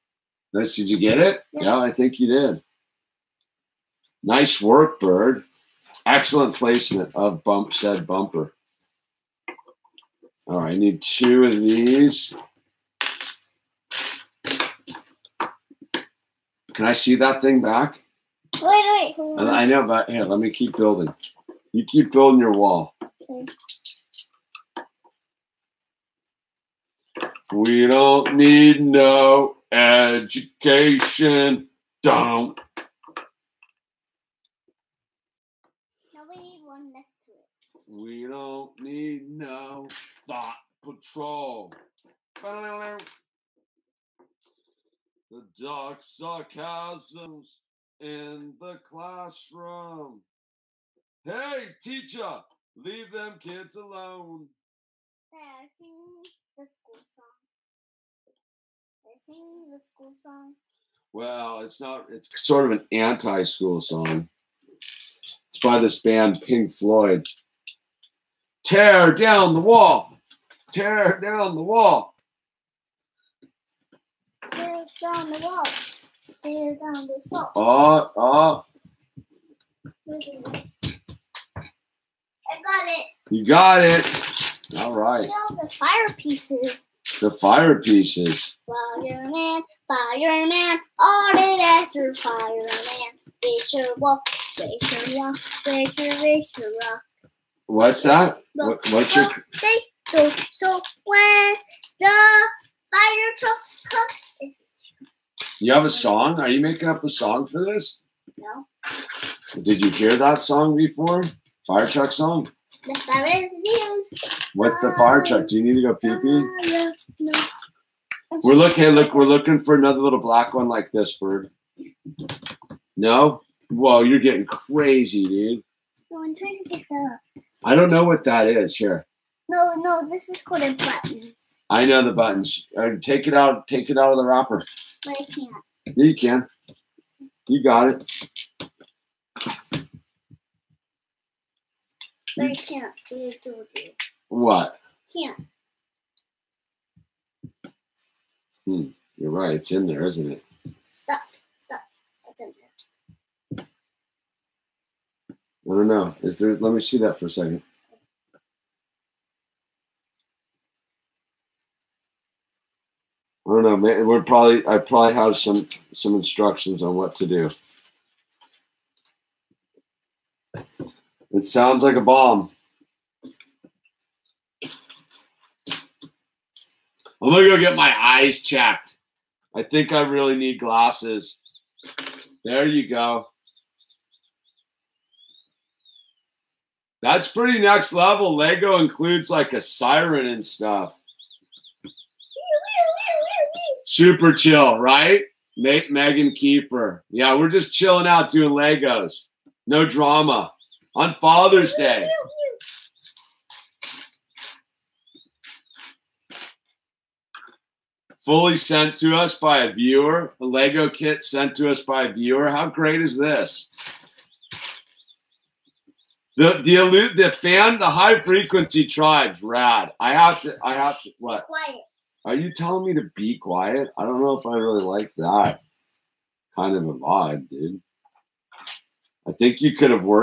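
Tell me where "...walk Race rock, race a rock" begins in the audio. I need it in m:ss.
1:33.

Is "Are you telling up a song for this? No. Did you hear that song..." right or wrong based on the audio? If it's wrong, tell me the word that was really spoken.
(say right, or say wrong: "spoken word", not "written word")
wrong: "making", not "telling".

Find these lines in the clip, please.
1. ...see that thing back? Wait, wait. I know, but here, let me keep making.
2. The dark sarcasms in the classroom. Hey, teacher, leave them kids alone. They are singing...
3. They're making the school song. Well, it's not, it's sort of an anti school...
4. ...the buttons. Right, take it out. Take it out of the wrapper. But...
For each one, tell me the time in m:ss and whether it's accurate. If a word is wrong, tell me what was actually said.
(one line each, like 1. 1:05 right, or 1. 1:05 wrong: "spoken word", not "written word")
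1. 0:16 wrong: "building", not "making"
2. 0:45 right
3. 0:59 wrong: "singing", not "making"
4. 2:12 right.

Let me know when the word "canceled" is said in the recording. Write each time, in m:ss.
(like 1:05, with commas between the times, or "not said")
not said.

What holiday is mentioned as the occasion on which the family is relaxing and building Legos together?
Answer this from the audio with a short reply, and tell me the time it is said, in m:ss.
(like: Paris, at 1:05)
Father's Day, at 3:21.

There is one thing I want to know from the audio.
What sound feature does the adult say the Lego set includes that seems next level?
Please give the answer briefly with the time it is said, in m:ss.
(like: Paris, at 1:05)
a siren, at 3:09.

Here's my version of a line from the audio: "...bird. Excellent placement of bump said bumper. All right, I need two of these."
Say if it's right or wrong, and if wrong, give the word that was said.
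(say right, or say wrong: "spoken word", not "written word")
right.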